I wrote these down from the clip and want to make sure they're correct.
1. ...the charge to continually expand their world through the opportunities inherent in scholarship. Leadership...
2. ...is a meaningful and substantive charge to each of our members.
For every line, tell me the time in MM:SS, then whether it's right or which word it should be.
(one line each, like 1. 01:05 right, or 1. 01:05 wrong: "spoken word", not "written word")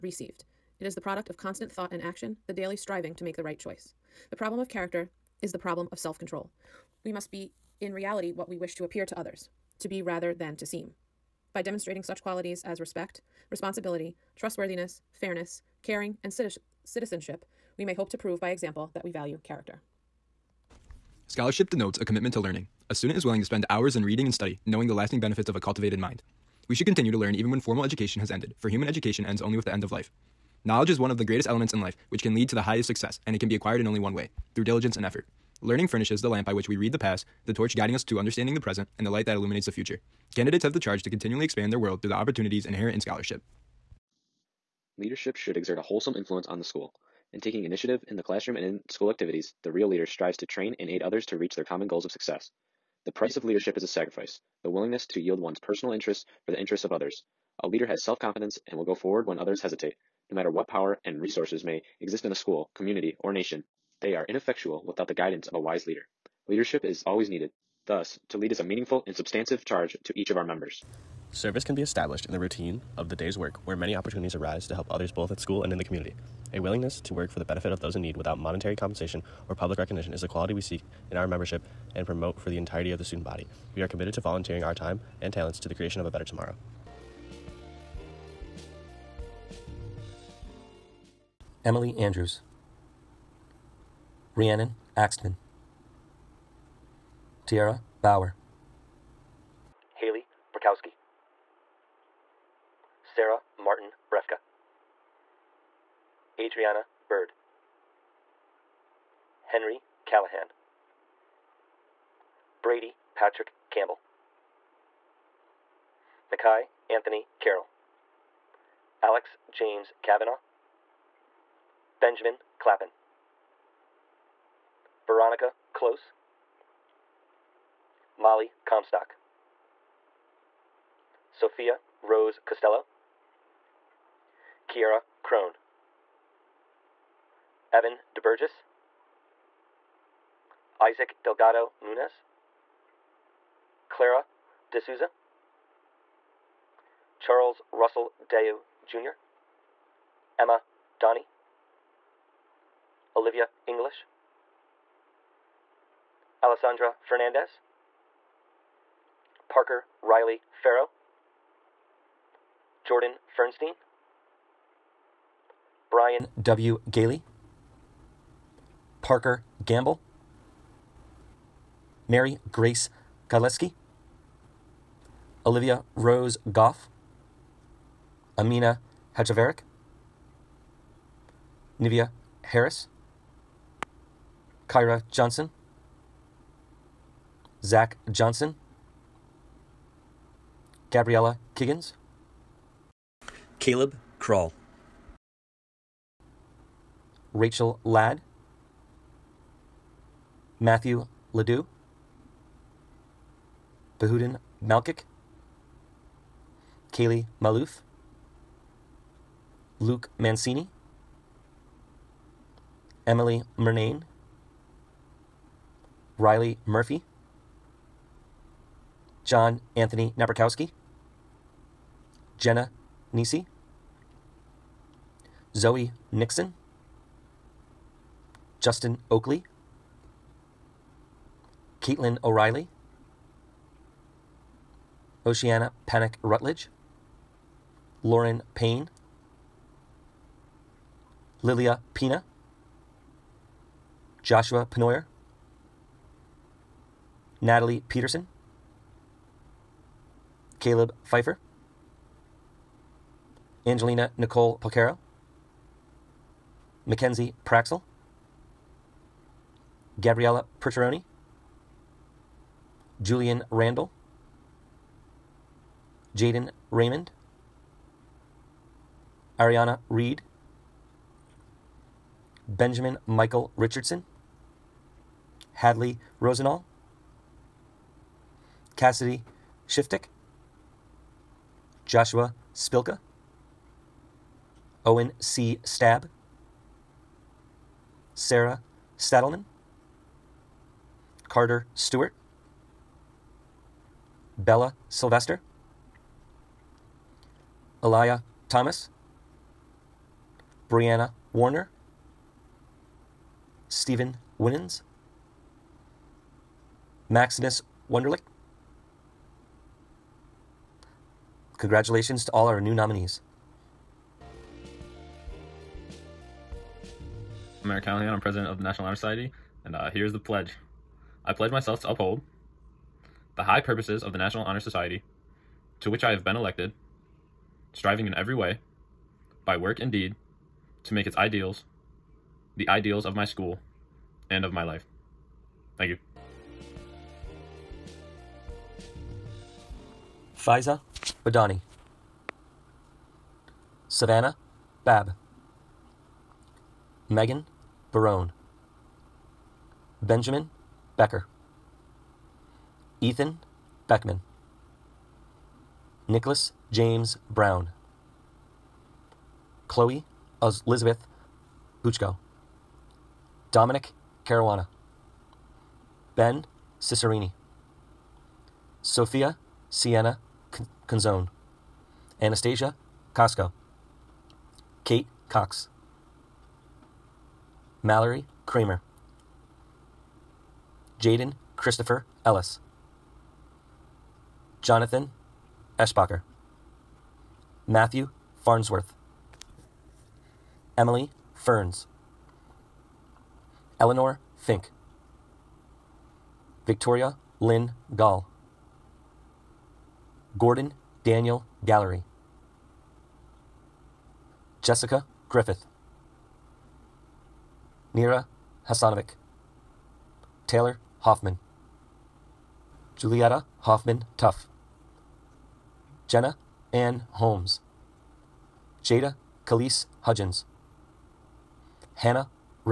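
1. 00:40 right
2. 01:08 right.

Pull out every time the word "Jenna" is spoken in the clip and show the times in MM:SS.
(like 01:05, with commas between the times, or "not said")
03:42, 06:56.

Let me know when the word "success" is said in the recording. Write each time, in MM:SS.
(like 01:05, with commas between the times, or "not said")
00:32, 00:52.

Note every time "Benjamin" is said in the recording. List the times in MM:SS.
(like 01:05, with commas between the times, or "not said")
02:02, 04:32, 05:50.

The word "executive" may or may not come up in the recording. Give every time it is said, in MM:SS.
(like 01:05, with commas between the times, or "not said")
not said.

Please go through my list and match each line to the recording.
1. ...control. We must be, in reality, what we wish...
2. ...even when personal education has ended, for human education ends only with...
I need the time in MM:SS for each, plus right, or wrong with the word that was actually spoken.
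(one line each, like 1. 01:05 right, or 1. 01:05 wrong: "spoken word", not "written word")
1. 00:06 right
2. 00:27 wrong: "formal", not "personal".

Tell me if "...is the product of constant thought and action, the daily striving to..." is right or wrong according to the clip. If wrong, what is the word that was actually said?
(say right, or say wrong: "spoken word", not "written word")
right.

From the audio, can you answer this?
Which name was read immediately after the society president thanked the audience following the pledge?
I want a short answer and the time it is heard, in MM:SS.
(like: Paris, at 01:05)
Faiza Badani, at 05:40.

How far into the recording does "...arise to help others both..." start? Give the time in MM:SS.
01:14.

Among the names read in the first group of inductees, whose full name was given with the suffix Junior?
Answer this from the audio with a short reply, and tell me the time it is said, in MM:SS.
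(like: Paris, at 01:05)
Charles Russell Deu Jr., at 02:27.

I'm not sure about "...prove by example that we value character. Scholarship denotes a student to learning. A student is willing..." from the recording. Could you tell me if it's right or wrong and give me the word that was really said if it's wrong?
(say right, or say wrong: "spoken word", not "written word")
wrong: "commitment", not "student".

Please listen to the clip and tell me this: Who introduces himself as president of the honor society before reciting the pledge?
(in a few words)
Eric Callahan.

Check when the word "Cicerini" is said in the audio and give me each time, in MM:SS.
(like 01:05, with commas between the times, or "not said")
06:06.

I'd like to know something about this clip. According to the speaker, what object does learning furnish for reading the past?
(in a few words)
The lamp.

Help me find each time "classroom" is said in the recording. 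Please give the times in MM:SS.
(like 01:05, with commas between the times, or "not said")
00:48.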